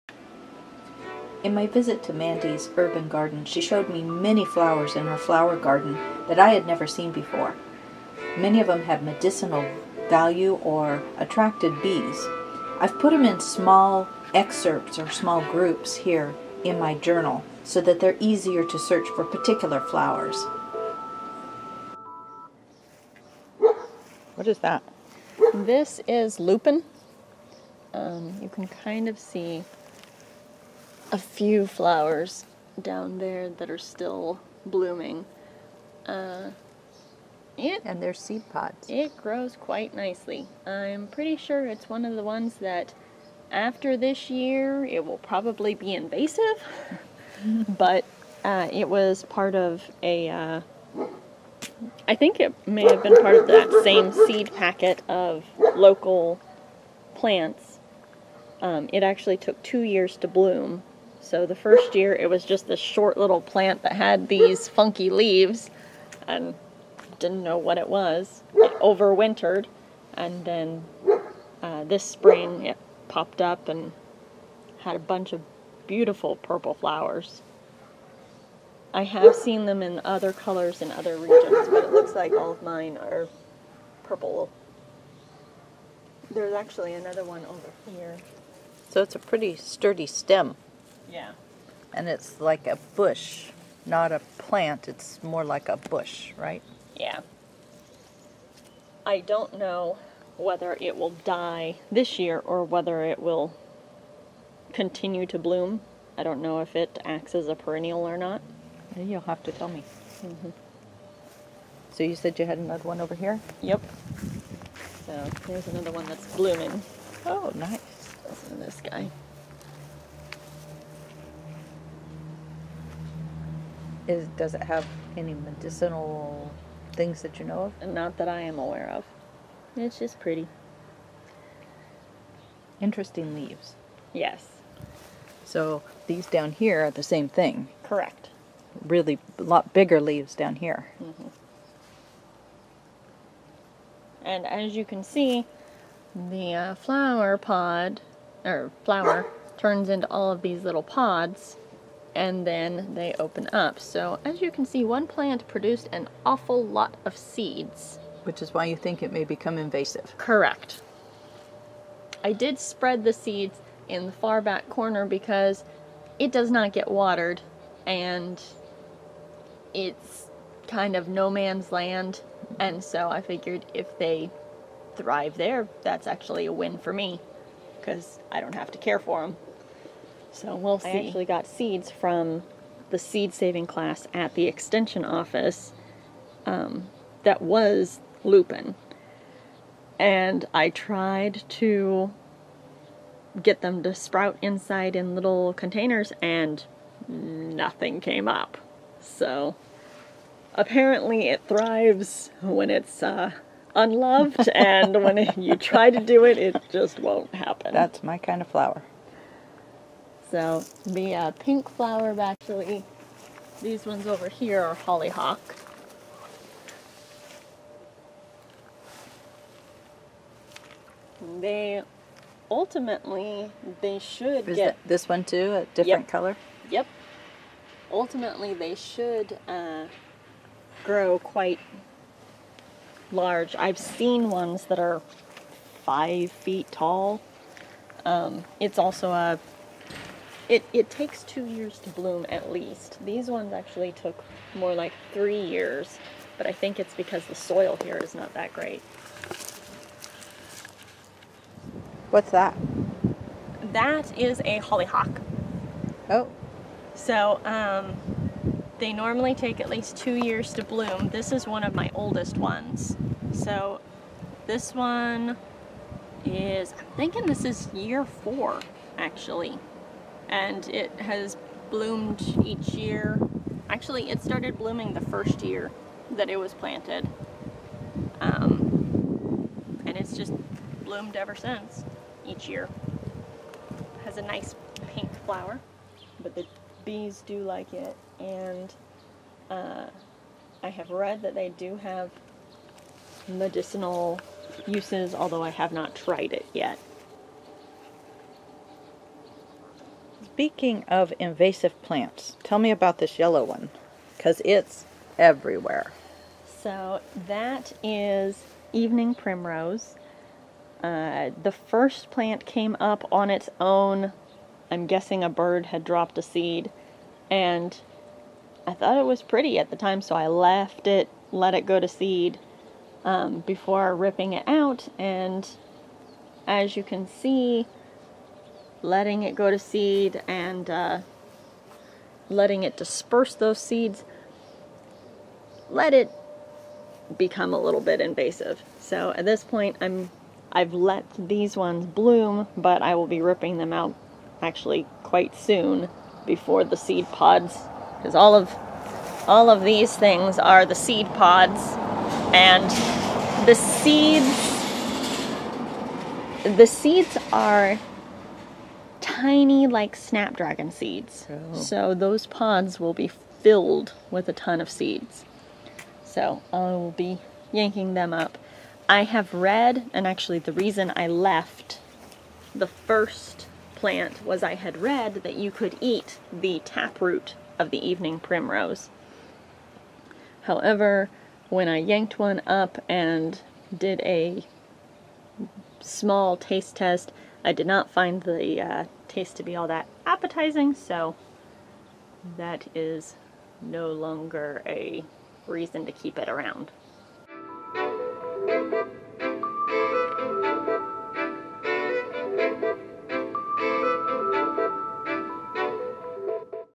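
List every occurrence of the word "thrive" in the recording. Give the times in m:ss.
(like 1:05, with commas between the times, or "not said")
2:54, 3:21.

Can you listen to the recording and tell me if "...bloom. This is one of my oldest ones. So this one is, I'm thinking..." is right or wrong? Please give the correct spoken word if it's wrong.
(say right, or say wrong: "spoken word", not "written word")
right.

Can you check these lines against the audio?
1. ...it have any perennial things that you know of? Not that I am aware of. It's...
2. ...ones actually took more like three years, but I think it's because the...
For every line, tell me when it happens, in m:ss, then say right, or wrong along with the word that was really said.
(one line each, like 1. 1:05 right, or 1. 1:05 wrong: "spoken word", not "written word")
1. 2:04 wrong: "medicinal", not "perennial"
2. 4:03 right.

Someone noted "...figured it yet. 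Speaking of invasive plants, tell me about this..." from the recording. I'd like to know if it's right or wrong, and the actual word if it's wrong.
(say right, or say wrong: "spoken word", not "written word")
wrong: "tried", not "figured".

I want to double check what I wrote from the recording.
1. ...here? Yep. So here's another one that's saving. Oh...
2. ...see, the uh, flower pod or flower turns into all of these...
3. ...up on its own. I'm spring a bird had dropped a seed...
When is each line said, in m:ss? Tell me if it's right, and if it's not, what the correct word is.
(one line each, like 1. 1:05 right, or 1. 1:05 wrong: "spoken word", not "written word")
1. 1:53 wrong: "blooming", not "saving"
2. 2:25 right
3. 5:12 wrong: "guessing", not "spring".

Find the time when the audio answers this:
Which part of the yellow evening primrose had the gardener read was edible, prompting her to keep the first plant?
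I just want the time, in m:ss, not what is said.
6:16.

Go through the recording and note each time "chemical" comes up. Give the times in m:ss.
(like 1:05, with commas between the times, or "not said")
not said.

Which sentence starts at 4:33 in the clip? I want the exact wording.
Actually, it started blooming the first year that it was planted.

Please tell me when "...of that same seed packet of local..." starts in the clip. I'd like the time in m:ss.
0:53.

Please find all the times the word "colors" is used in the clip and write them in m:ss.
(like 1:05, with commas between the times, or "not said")
1:20, 3:46.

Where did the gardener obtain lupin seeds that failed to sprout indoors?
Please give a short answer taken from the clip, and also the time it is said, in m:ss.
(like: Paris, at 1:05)
Seed saving class at the extension office, at 3:02.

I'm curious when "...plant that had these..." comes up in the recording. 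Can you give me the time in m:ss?
1:03.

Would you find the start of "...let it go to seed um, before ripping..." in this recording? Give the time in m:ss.
5:21.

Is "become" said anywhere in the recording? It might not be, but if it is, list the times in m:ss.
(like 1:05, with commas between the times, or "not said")
2:39, 5:37.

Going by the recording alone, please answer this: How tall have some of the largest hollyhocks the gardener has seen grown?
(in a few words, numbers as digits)
5 feet.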